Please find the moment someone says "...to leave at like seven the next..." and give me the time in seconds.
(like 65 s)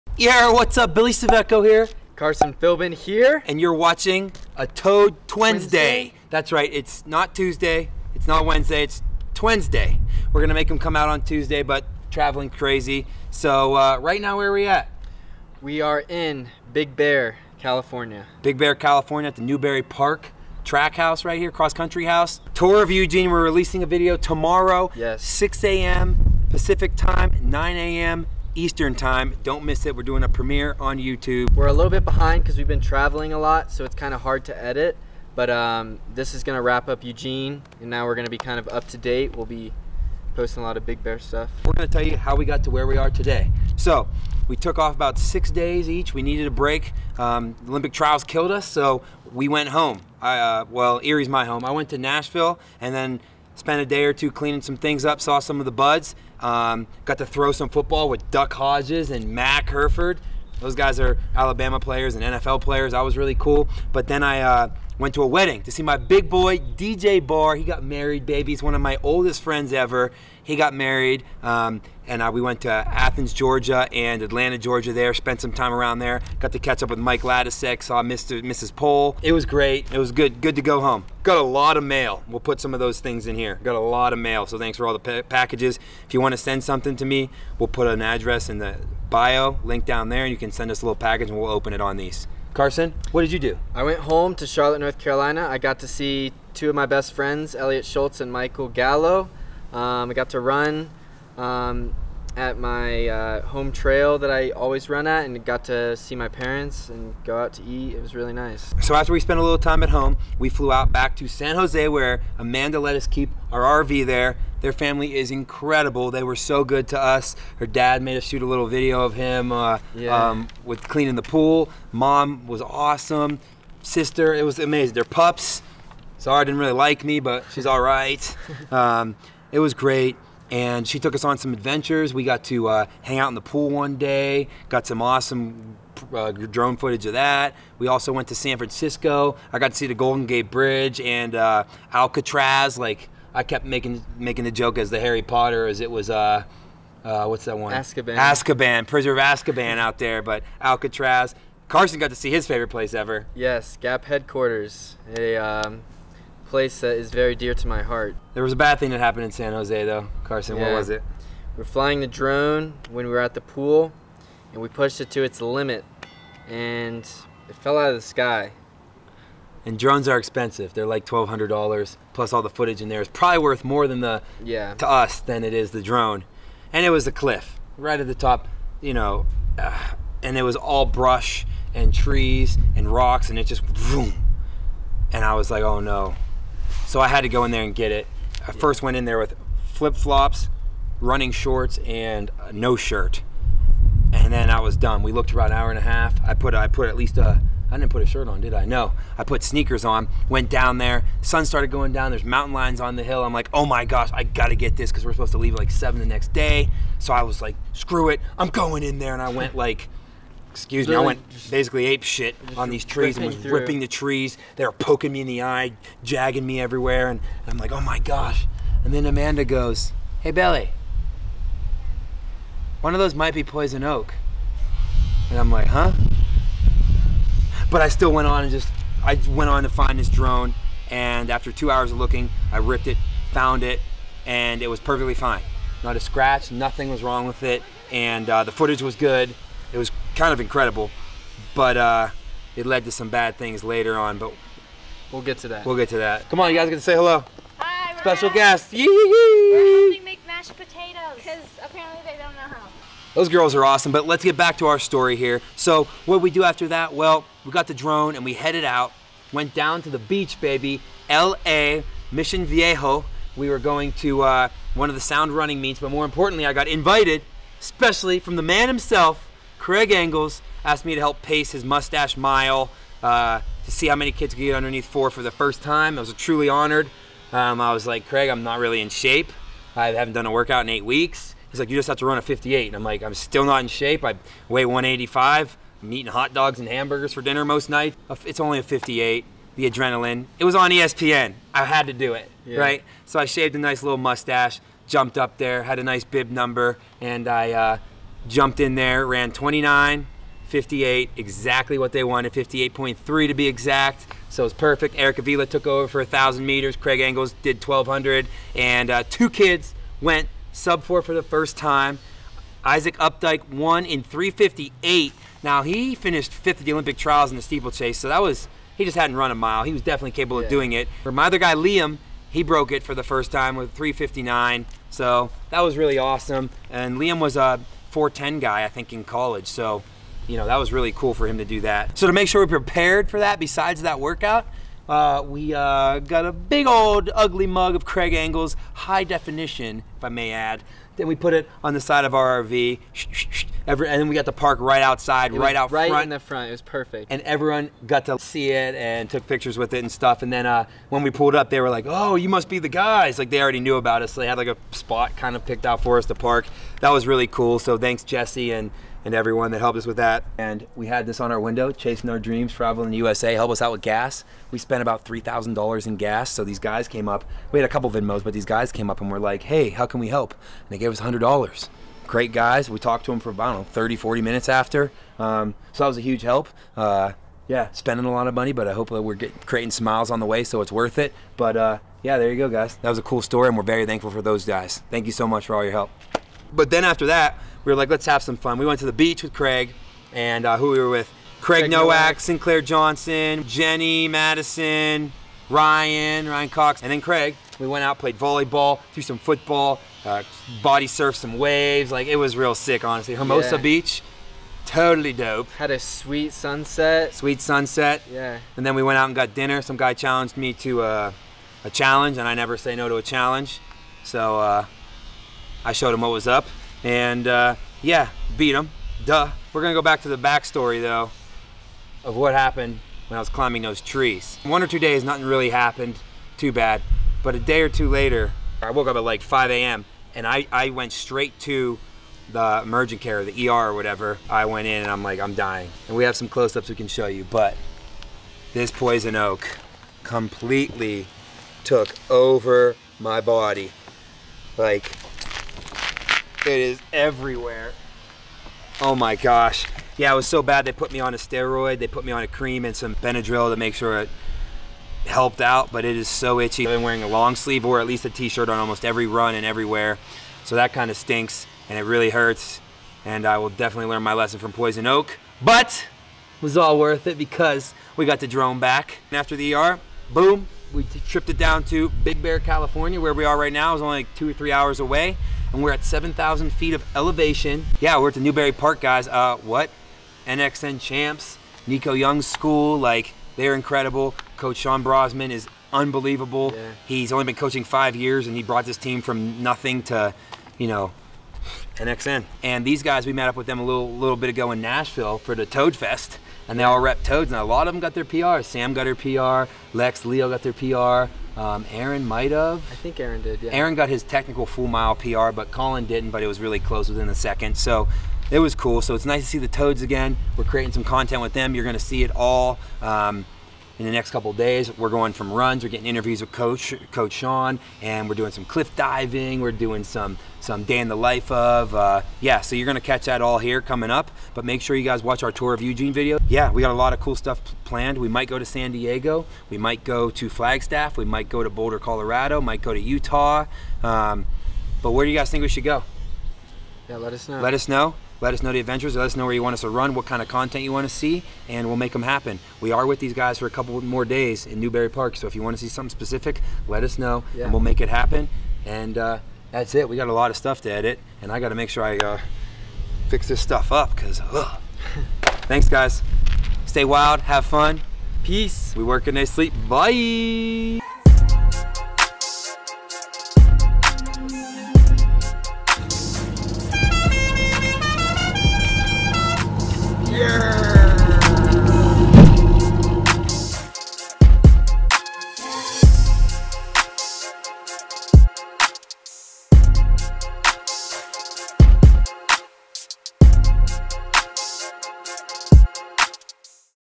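205 s.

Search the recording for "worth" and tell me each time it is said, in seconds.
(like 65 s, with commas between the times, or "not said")
173 s, 380 s, 466 s.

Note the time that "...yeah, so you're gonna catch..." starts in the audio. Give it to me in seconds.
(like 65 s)
522 s.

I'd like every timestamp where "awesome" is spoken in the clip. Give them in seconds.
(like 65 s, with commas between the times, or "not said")
122 s, 135 s, 253 s, 325 s.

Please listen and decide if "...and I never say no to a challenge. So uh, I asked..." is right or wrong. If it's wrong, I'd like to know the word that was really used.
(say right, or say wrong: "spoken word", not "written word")
wrong: "showed", not "asked".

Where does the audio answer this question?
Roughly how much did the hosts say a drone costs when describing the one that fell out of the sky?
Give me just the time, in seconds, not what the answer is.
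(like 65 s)
171 s.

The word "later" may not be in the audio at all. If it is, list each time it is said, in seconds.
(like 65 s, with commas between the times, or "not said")
243 s, 427 s.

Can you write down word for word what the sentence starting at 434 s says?
I went in and I'm like, I'm dying.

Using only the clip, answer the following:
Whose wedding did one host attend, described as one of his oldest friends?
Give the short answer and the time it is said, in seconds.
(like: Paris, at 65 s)
DJ Barr, at 66 s.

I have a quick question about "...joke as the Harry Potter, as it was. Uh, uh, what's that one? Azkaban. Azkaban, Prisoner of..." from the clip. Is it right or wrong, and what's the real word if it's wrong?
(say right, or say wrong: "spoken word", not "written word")
right.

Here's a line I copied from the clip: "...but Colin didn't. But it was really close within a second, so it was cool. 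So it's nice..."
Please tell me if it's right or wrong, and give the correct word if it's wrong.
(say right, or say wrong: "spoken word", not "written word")
right.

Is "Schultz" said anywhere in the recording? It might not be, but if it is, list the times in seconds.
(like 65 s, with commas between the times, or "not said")
97 s.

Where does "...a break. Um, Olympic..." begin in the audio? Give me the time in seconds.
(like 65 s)
46 s.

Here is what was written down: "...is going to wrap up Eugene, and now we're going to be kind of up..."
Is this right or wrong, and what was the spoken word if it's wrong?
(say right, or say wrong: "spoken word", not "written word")
right.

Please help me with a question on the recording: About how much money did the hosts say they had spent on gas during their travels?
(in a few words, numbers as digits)
$3,000.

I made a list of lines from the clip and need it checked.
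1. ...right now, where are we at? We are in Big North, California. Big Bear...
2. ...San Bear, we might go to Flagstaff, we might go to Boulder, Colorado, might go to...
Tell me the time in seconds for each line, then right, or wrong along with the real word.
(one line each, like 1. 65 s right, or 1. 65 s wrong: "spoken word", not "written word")
1. 13 s wrong: "Bear", not "North"
2. 528 s wrong: "Diego", not "Bear".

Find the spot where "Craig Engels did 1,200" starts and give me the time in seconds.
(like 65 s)
306 s.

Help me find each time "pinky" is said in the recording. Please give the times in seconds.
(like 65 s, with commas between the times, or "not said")
not said.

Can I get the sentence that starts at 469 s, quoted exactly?
And after the ER, boom, we tripped it down to Big Bear, California, where we are right now.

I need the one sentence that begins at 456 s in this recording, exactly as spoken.
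I've been wearing a long sleeve or at least a t-shirt on almost every run and everywhere.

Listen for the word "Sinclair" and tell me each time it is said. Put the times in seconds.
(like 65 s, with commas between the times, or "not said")
392 s.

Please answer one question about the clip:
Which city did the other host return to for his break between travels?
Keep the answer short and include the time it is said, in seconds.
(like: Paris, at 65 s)
Charlotte, North Carolina, at 94 s.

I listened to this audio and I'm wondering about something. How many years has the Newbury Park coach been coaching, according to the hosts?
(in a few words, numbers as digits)
5.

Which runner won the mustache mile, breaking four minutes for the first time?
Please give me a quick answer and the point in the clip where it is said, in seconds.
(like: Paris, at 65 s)
Isaac Updike, at 312 s.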